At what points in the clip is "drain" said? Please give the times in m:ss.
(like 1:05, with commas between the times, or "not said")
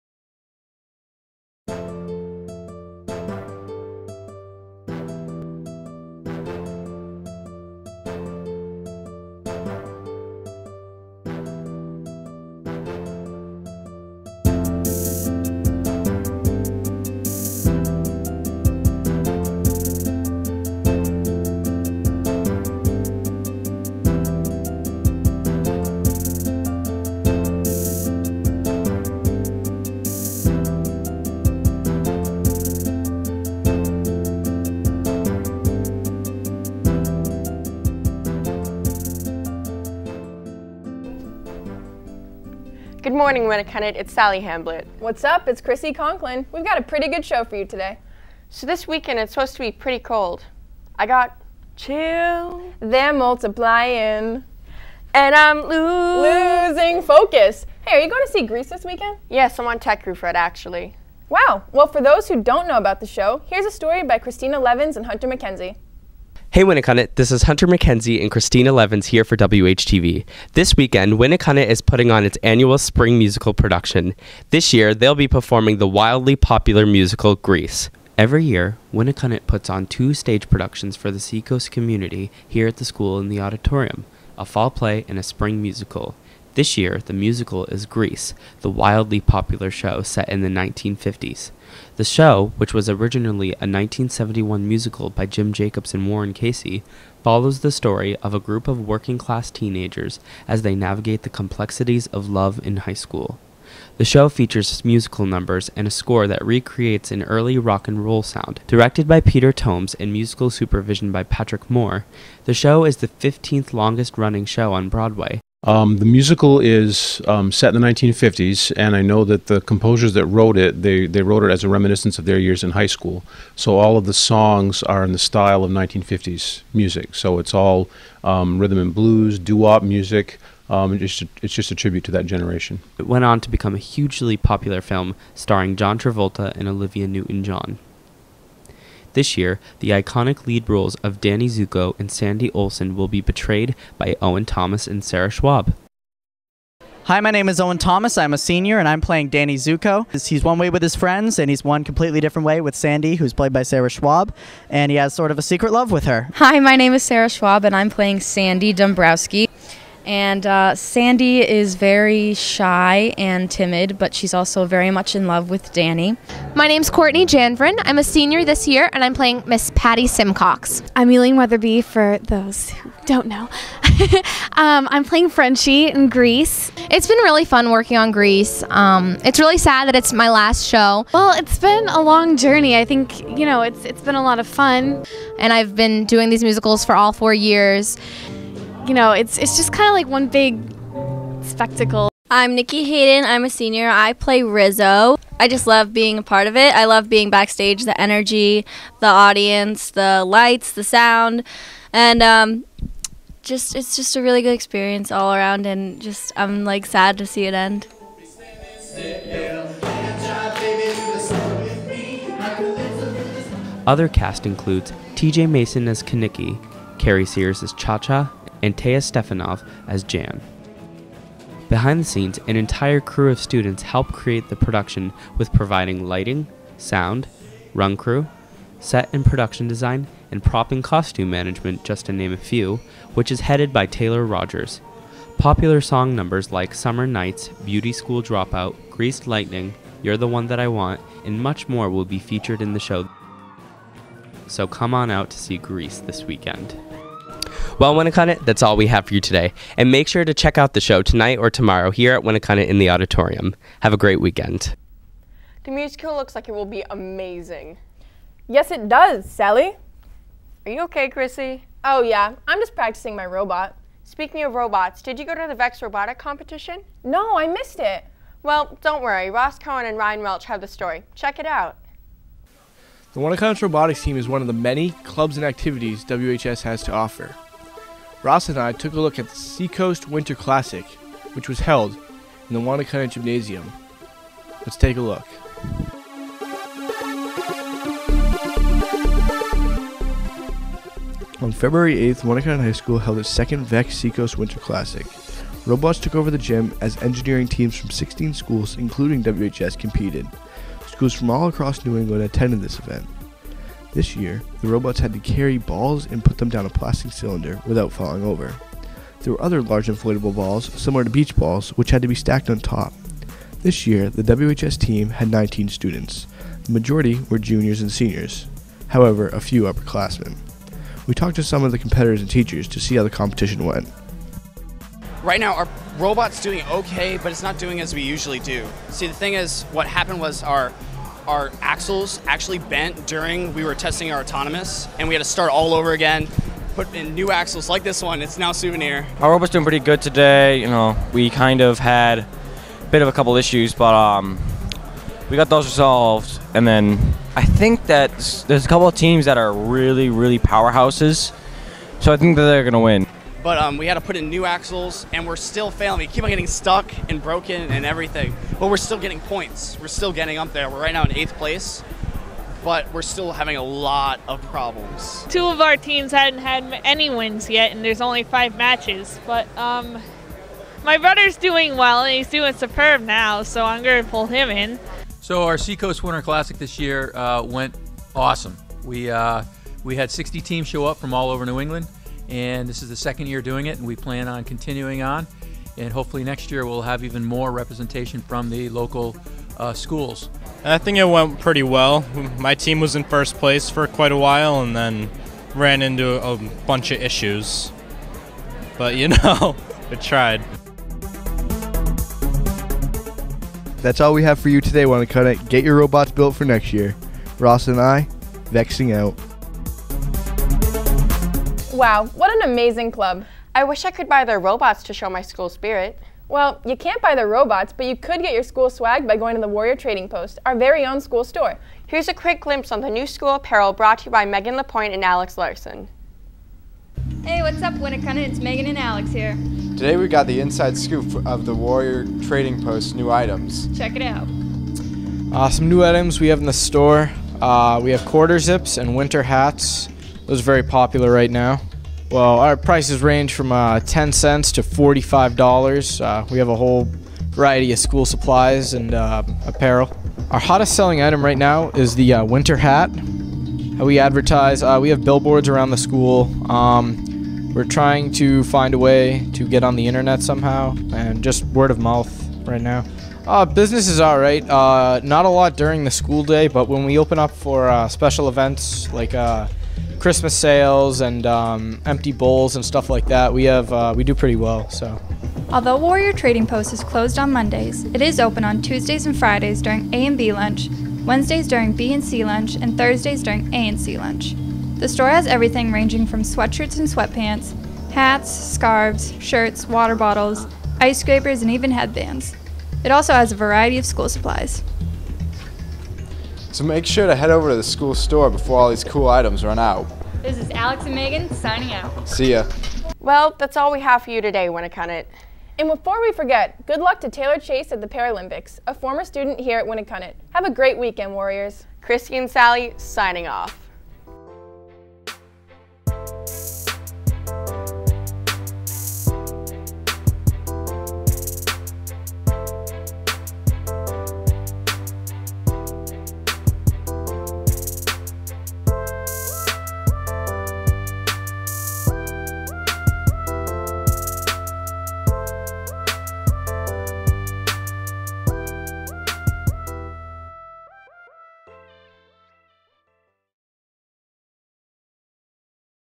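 not said.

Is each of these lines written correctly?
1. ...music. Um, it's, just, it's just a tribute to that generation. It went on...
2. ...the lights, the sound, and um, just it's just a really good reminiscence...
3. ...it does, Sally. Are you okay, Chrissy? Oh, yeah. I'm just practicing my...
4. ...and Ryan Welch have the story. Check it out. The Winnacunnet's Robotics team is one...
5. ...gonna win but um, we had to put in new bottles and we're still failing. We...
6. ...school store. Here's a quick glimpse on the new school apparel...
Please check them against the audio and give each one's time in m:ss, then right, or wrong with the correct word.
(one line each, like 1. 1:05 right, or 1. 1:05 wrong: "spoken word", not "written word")
1. 2:09 right
2. 3:19 wrong: "experience", not "reminiscence"
3. 4:18 right
4. 4:29 right
5. 5:52 wrong: "axles", not "bottles"
6. 7:00 right.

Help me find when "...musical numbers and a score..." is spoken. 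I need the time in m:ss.
1:44.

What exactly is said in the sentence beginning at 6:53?
I wish I could buy their robots to show my school spirit.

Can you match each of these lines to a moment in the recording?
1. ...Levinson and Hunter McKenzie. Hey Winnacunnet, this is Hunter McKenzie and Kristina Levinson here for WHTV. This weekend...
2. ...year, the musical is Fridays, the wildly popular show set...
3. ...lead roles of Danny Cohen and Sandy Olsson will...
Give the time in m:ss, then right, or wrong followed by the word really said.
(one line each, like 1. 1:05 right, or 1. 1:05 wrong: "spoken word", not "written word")
1. 1:04 right
2. 1:26 wrong: "Grease", not "Fridays"
3. 2:20 wrong: "Zuko", not "Cohen".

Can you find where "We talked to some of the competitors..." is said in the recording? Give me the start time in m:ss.
5:21.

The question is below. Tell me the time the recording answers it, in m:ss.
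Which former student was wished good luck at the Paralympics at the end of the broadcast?
8:27.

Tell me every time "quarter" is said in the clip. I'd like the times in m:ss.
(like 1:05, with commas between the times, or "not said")
7:18.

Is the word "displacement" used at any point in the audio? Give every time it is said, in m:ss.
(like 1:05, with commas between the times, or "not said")
not said.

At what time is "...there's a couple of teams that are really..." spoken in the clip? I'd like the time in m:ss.
5:48.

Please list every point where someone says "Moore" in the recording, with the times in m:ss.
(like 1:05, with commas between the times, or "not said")
1:51.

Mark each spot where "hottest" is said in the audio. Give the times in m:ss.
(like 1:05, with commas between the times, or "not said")
7:30.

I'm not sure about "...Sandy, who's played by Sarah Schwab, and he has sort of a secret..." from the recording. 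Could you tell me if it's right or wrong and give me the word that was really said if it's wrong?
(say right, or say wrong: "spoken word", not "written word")
right.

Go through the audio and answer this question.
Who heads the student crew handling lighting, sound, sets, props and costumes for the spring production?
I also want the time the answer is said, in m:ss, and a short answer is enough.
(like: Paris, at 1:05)
Taylor Rogers, at 3:53.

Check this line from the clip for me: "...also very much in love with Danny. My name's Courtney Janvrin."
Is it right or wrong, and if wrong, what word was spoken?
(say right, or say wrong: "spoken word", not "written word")
right.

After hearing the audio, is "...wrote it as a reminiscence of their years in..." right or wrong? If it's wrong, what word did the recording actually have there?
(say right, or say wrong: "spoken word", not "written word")
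right.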